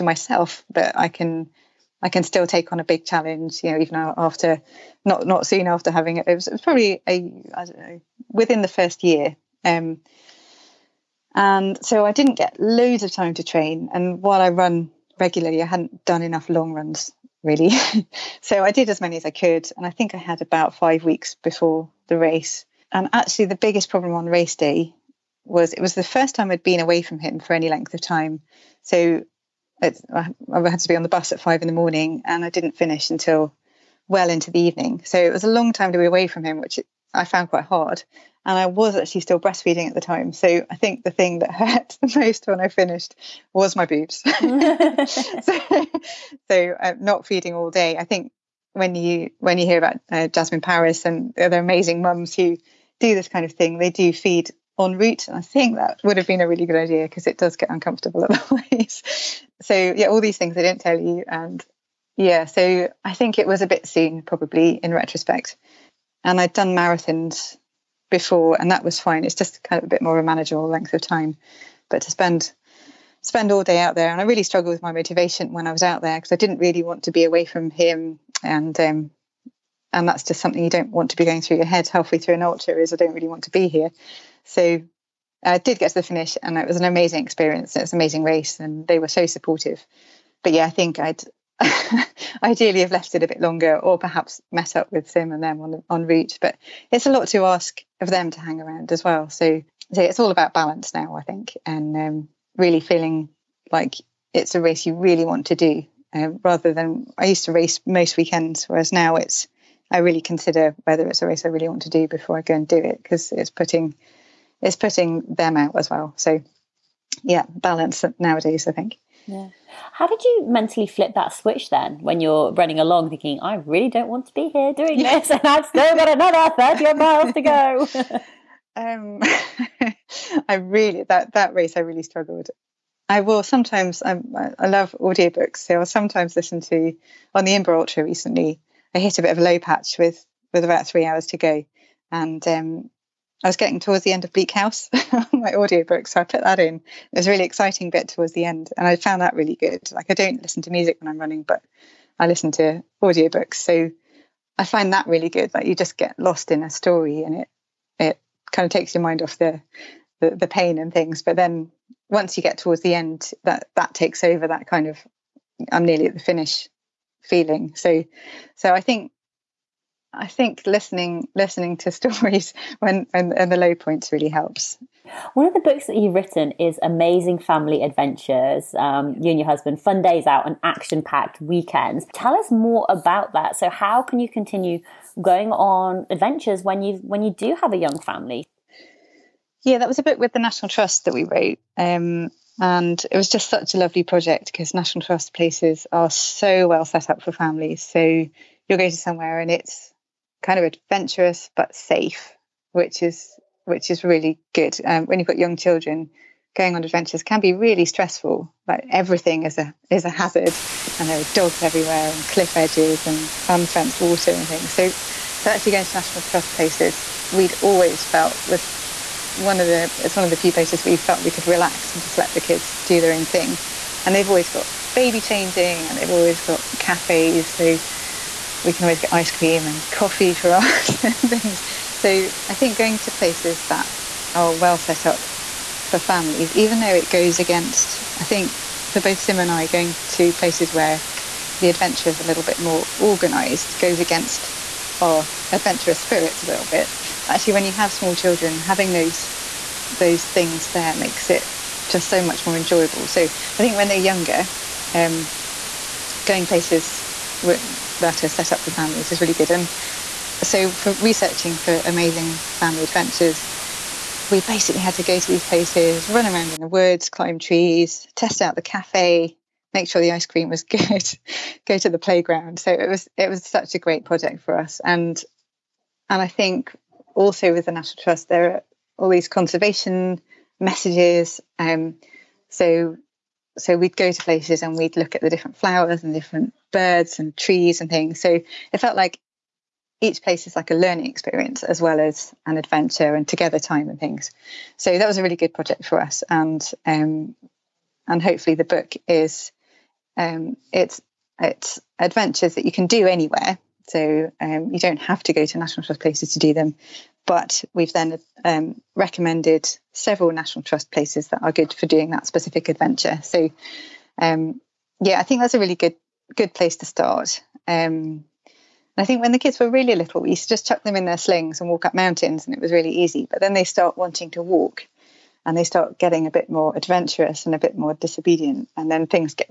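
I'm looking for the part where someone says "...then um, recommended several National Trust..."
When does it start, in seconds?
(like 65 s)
307 s.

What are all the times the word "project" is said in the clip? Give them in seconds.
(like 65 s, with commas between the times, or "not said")
194 s, 274 s, 295 s.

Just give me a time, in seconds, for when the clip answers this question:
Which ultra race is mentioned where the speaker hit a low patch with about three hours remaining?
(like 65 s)
137 s.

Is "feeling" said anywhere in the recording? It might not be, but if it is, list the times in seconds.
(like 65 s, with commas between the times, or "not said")
102 s, 167 s.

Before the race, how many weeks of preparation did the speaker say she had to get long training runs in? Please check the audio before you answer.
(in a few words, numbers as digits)
5.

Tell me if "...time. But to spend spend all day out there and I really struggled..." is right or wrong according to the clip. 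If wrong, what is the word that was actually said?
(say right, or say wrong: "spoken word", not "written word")
right.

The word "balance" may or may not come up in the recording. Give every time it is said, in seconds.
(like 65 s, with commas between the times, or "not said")
100 s, 117 s.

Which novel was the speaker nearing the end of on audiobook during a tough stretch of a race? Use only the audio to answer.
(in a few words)
Bleak House.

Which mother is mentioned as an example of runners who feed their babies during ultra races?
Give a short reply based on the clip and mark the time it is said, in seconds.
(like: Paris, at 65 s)
Jasmin Paris, at 50 s.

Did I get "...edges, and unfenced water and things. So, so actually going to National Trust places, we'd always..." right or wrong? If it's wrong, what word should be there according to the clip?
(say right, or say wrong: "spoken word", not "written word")
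right.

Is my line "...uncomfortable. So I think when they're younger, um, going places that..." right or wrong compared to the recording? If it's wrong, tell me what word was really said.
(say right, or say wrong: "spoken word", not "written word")
wrong: "enjoyable", not "uncomfortable".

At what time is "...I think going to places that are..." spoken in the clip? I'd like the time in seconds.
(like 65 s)
232 s.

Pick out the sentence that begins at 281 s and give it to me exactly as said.
Um, so so we'd go to places and we'd look at the different flowers and different birds and trees and things.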